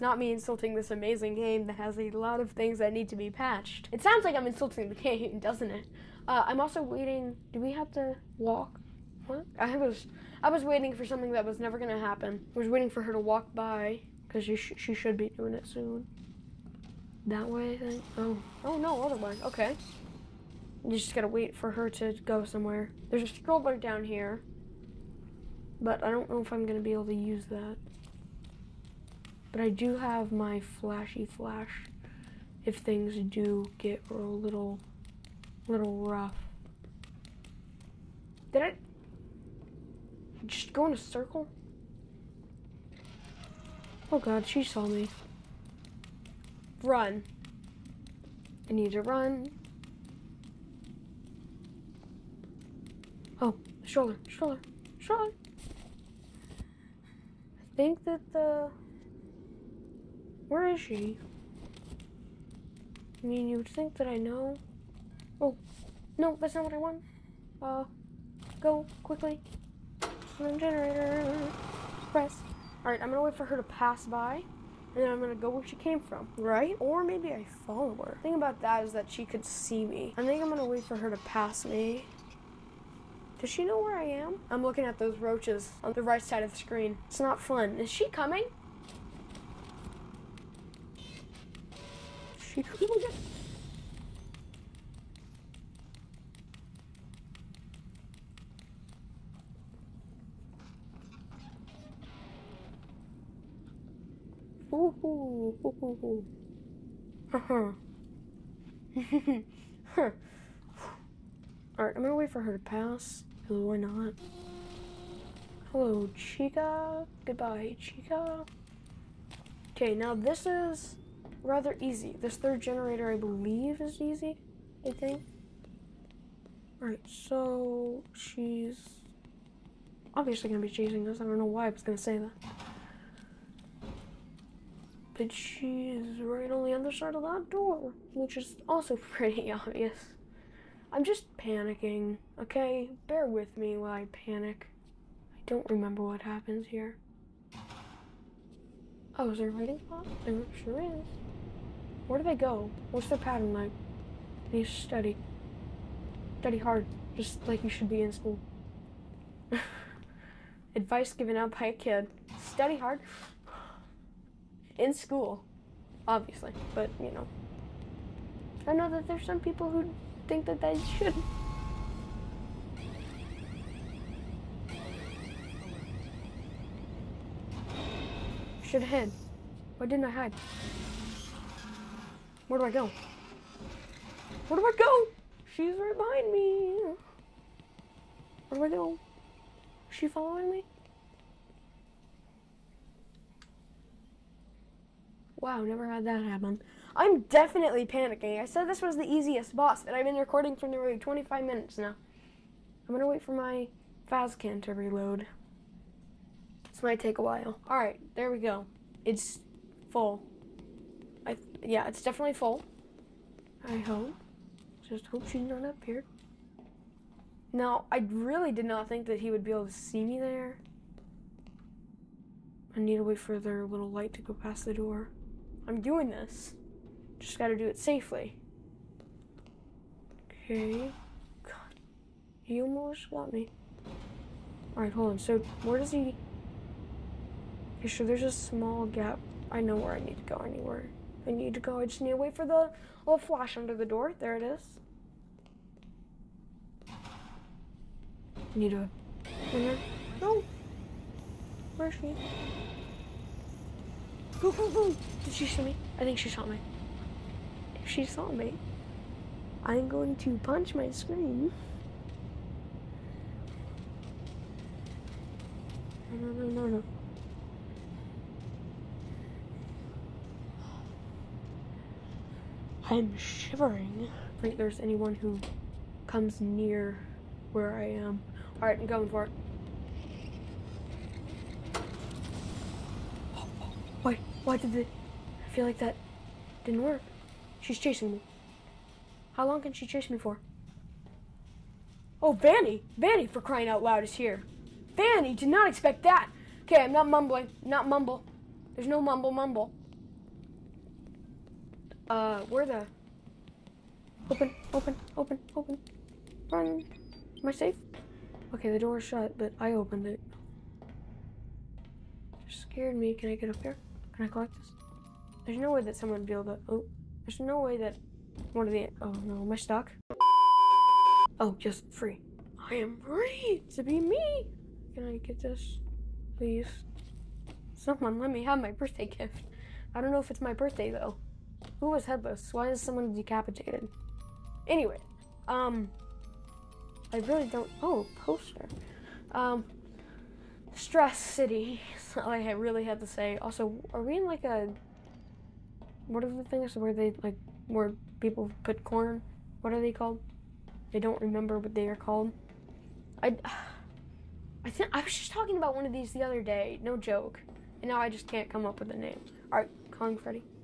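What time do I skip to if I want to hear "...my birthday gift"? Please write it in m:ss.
5:28.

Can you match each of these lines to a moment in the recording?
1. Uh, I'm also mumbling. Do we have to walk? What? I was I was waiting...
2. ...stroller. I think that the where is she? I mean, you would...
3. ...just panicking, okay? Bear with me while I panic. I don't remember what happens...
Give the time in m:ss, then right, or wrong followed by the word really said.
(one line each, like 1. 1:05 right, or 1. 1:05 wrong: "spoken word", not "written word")
1. 0:06 wrong: "waiting", not "mumbling"
2. 0:54 right
3. 2:21 right.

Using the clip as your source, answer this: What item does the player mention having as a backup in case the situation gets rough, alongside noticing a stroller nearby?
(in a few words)
flashy flash.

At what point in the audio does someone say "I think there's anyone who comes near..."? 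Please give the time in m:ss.
4:34.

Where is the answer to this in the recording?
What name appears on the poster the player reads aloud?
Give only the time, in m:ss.
5:40.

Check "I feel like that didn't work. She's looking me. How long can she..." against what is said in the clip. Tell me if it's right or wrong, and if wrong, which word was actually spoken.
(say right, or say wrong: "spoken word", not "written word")
wrong: "chasing", not "looking".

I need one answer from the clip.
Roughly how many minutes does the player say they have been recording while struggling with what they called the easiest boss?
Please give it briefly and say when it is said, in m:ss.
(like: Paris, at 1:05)
25, at 3:20.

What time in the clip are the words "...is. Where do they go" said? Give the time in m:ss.
2:30.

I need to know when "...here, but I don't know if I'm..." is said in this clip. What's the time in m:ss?
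0:24.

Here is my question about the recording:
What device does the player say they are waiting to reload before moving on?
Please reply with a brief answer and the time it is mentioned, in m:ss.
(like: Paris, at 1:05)
Faz-Cam, at 3:23.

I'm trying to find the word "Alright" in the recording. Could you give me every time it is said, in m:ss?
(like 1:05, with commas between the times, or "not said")
1:12, 1:51, 2:06, 3:54.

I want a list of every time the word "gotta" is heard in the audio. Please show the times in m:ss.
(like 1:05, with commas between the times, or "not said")
0:21, 3:47.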